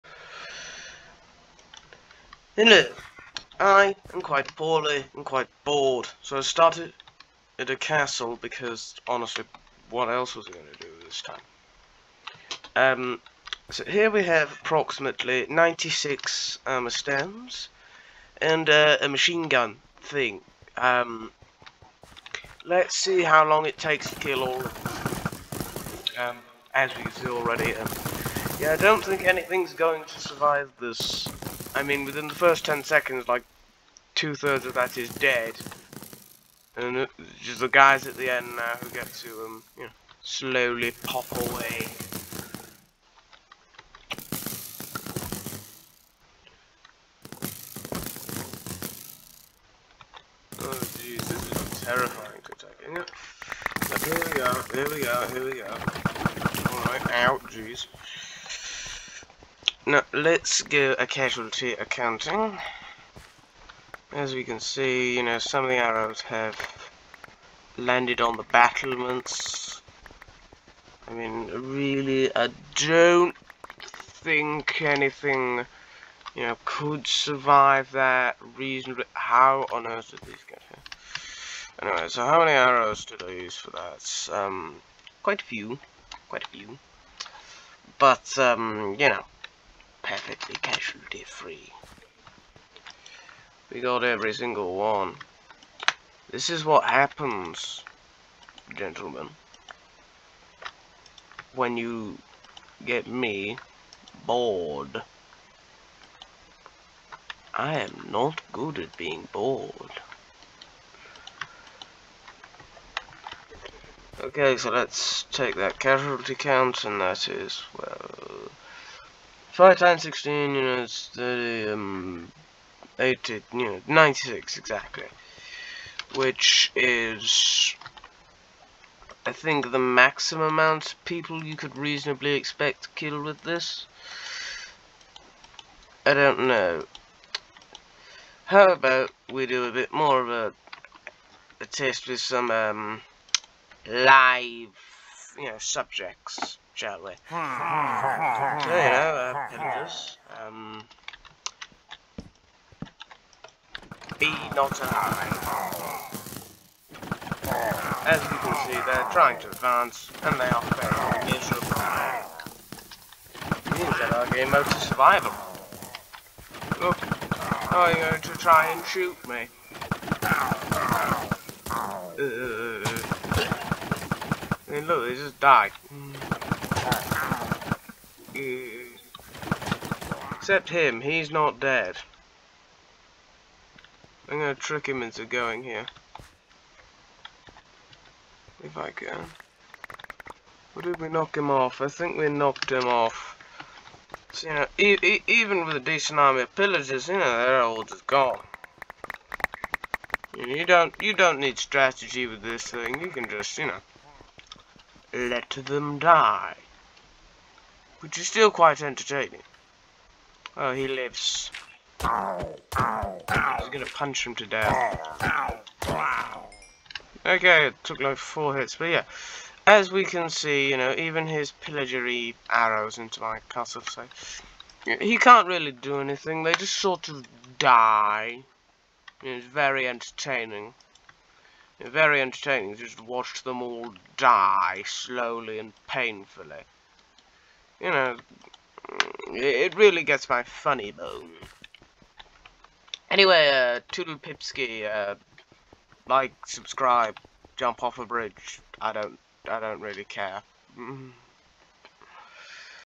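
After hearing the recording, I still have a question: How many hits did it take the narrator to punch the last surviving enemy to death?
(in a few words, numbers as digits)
4.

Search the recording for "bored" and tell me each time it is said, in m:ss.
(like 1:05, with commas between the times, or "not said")
0:05, 1:44, 1:49.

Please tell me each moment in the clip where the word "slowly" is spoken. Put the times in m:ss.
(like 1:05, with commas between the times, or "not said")
0:40, 3:54.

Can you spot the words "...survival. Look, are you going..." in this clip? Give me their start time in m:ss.
2:44.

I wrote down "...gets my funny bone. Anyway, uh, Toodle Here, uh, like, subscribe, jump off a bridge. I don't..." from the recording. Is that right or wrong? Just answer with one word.
wrong.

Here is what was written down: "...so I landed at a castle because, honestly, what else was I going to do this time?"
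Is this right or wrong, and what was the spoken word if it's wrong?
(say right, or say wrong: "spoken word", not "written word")
wrong: "started", not "landed".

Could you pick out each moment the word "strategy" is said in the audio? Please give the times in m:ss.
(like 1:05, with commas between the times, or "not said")
3:21.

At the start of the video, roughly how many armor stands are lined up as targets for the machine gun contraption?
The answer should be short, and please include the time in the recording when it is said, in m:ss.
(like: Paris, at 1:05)
96, at 0:14.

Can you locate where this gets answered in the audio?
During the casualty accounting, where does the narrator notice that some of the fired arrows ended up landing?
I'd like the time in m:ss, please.
1:08.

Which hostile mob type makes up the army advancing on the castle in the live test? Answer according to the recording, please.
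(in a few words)
Pillagers.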